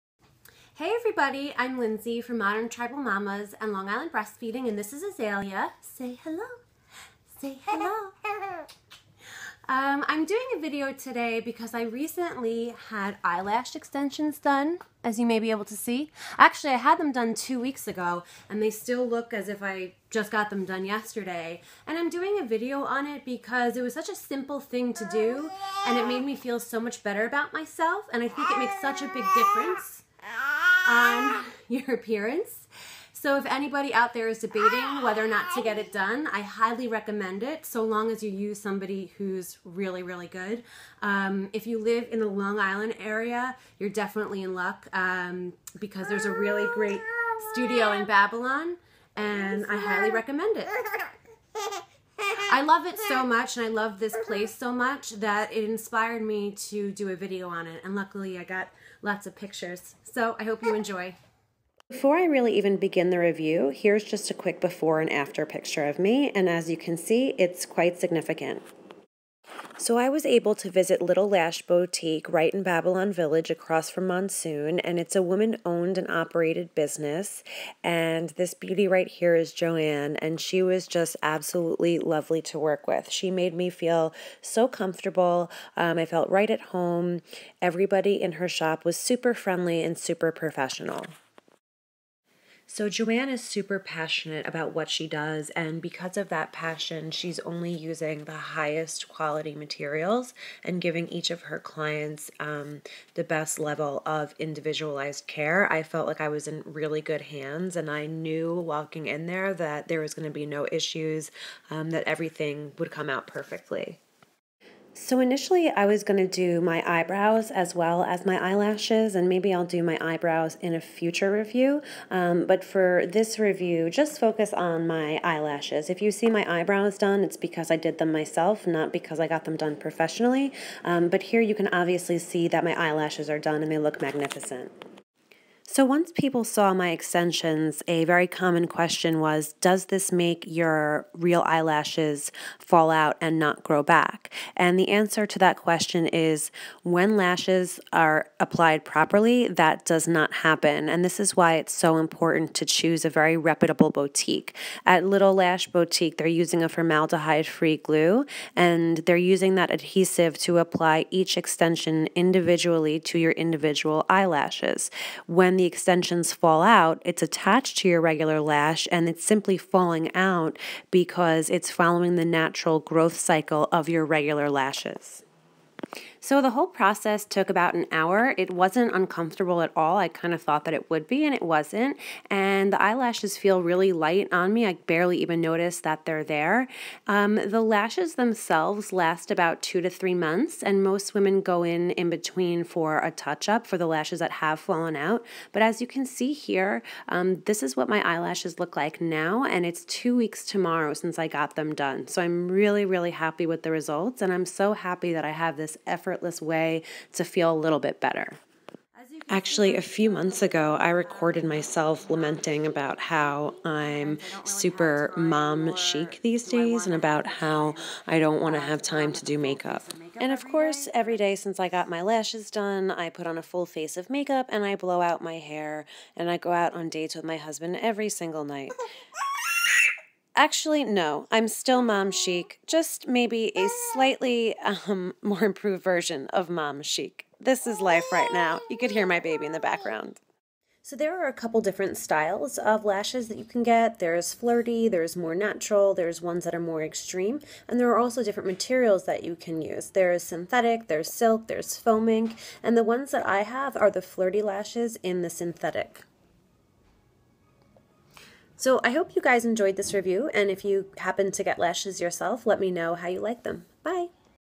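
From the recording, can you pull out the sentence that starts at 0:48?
Babylon and I highly recommend it.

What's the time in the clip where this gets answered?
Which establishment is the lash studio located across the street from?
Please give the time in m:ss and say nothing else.
1:14.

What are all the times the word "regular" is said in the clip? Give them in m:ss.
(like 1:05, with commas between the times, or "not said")
2:48, 2:54.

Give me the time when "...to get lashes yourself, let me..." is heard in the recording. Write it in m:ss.
4:21.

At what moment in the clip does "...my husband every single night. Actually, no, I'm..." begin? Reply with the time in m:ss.
3:47.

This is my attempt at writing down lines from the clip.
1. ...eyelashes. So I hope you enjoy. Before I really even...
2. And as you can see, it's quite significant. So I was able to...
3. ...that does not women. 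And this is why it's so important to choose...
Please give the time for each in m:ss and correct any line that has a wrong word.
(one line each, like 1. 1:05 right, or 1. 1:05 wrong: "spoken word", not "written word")
1. 0:59 wrong: "pictures", not "eyelashes"
2. 1:06 right
3. 2:29 wrong: "happen", not "women".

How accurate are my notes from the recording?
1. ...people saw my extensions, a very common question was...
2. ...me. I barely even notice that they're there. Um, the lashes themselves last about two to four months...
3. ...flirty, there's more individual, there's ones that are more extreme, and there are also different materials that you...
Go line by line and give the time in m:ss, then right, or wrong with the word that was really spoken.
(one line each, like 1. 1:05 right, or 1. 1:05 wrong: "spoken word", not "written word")
1. 2:16 right
2. 3:04 wrong: "three", not "four"
3. 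4:04 wrong: "natural", not "individual".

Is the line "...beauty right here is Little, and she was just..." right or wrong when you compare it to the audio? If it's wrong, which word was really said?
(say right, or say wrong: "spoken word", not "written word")
wrong: "Joanne", not "Little".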